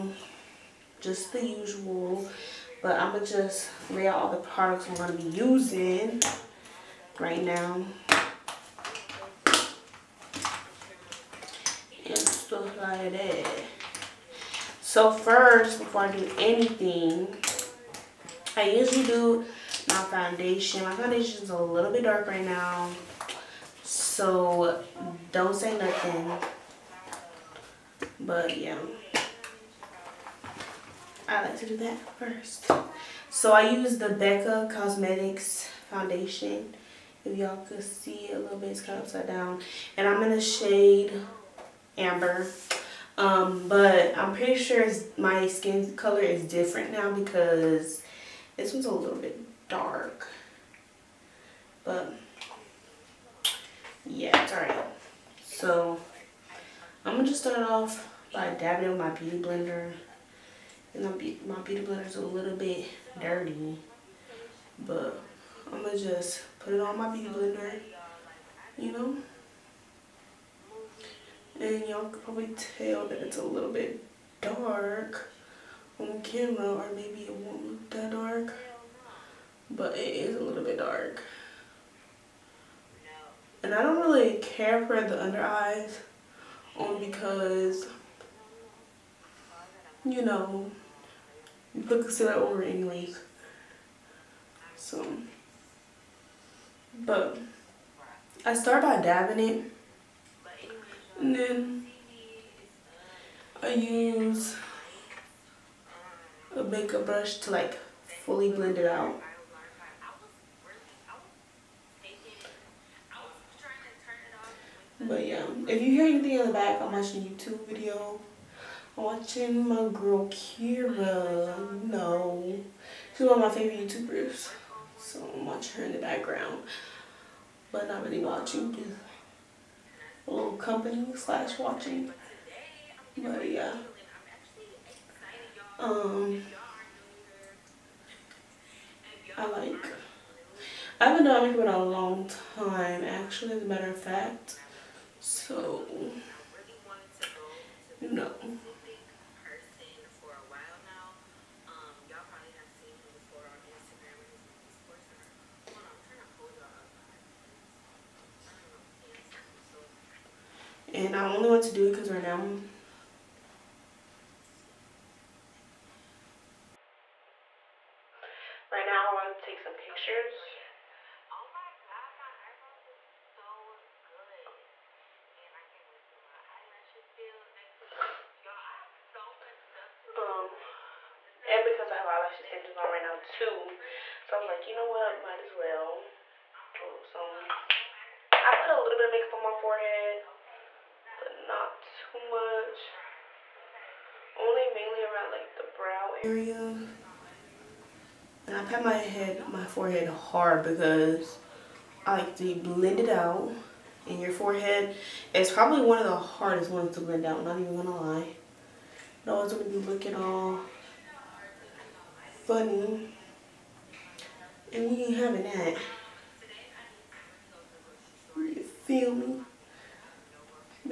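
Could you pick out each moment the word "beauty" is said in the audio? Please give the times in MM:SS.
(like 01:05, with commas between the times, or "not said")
00:59, 01:07.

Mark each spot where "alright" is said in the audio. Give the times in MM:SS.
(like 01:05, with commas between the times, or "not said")
00:54.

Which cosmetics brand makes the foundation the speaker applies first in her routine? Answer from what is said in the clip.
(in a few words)
Becca Cosmetics.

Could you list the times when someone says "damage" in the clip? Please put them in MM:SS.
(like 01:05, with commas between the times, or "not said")
not said.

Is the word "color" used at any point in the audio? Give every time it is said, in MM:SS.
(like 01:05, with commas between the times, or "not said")
00:45.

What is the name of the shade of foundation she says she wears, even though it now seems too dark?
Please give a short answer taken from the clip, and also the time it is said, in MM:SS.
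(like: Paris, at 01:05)
Amber, at 00:41.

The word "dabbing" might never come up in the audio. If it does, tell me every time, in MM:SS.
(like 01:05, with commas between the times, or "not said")
00:58, 01:39.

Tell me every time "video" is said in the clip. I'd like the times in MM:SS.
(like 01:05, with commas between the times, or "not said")
01:57.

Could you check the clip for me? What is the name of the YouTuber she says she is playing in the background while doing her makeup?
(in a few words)
Kira.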